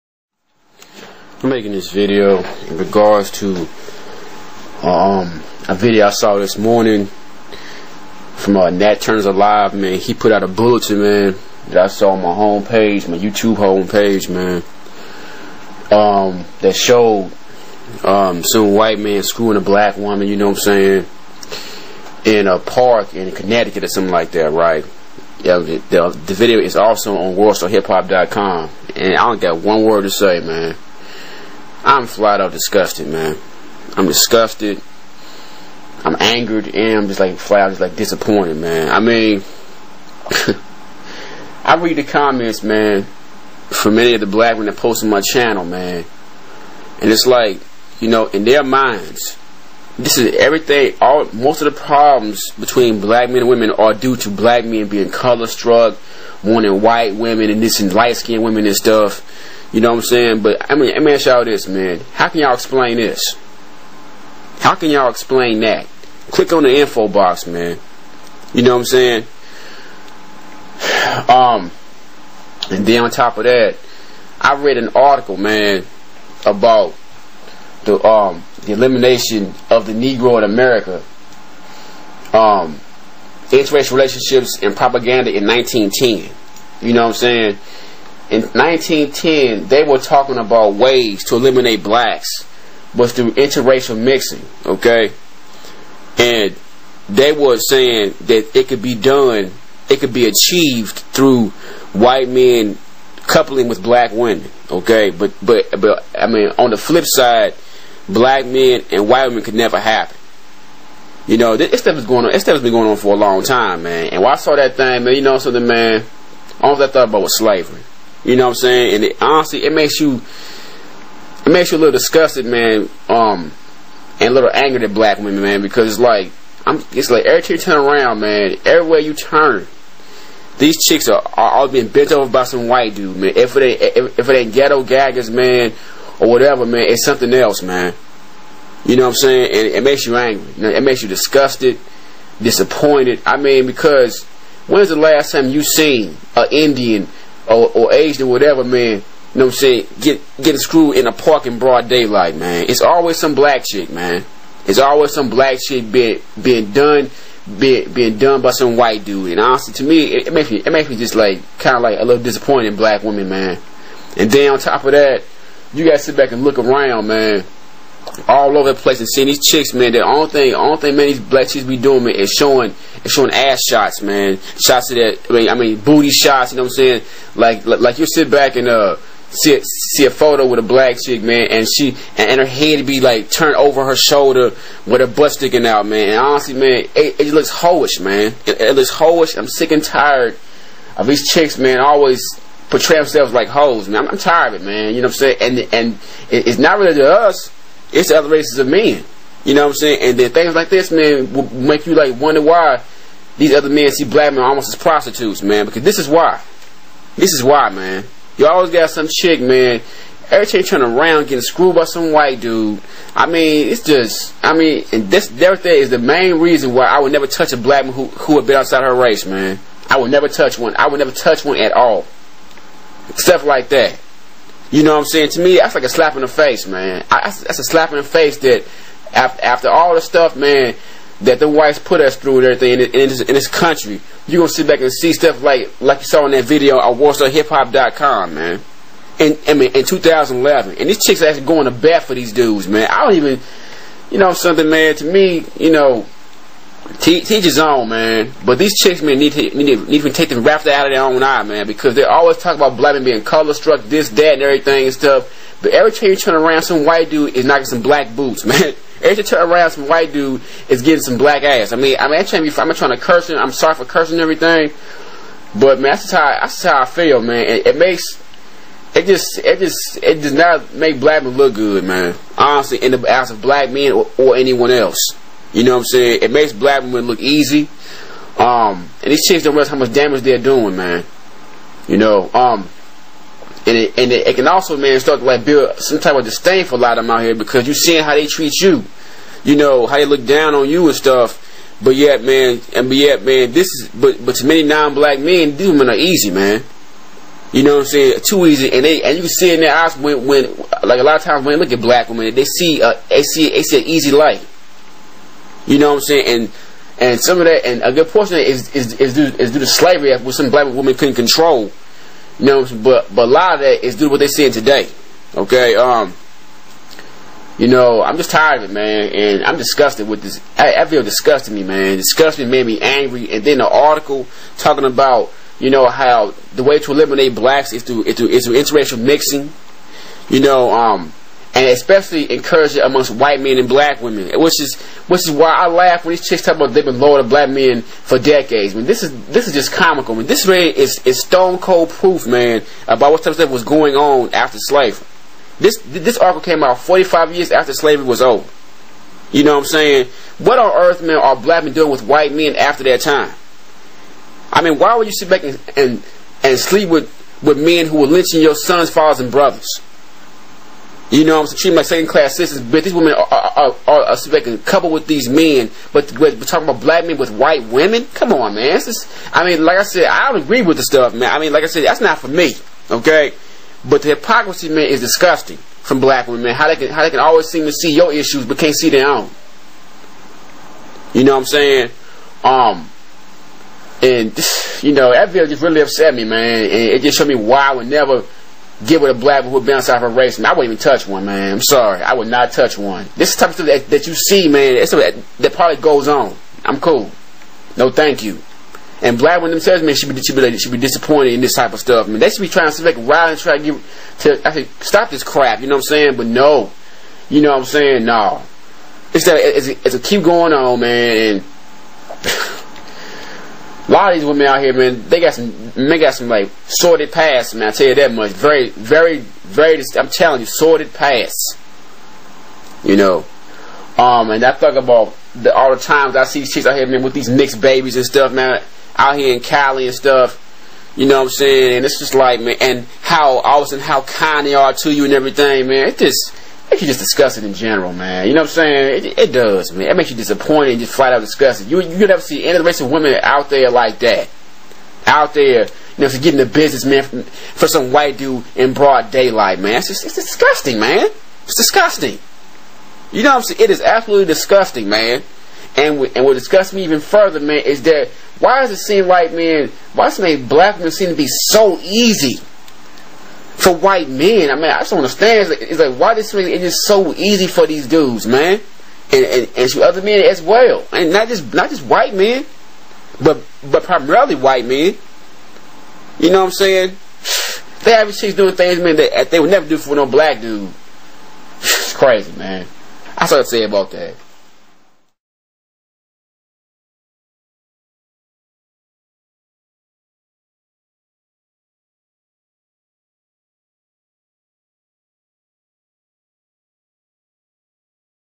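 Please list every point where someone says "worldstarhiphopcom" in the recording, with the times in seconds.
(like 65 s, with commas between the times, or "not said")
27 s, 236 s.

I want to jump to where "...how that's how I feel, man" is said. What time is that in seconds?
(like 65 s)
266 s.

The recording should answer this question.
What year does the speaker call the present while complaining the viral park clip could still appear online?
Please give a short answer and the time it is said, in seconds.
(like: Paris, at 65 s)
2011, at 239 s.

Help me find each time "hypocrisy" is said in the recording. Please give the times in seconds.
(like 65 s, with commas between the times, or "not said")
374 s.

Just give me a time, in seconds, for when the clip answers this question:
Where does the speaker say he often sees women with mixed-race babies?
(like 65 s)
429 s.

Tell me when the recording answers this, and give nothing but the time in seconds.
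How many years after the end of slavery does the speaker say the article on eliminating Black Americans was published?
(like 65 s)
346 s.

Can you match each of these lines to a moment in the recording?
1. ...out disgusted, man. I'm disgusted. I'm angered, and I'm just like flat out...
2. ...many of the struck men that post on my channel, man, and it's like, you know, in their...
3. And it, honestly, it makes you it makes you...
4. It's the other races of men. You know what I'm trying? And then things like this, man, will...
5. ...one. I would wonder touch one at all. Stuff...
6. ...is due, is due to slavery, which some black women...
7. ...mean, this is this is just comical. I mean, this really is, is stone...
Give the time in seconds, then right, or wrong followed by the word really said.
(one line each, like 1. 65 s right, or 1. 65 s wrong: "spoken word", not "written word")
1. 32 s right
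2. 43 s wrong: "black", not "struck"
3. 118 s right
4. 197 s wrong: "saying", not "trying"
5. 220 s wrong: "never", not "wonder"
6. 308 s right
7. 338 s right.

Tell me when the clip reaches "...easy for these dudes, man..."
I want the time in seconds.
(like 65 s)
467 s.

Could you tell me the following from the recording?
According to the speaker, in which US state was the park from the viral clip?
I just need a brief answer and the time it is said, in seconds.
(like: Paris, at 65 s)
Connecticut, at 23 s.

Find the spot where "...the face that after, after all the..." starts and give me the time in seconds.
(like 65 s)
227 s.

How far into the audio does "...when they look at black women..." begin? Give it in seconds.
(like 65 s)
301 s.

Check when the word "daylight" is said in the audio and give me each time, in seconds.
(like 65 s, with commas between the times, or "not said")
151 s, 449 s.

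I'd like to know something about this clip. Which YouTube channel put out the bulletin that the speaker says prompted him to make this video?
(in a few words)
Nat Turner's Alive.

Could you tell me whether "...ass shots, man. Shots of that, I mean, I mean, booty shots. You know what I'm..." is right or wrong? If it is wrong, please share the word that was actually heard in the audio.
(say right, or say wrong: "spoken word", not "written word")
right.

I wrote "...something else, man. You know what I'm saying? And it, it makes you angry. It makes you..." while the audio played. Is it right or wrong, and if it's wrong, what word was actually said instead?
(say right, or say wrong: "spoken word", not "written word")
right.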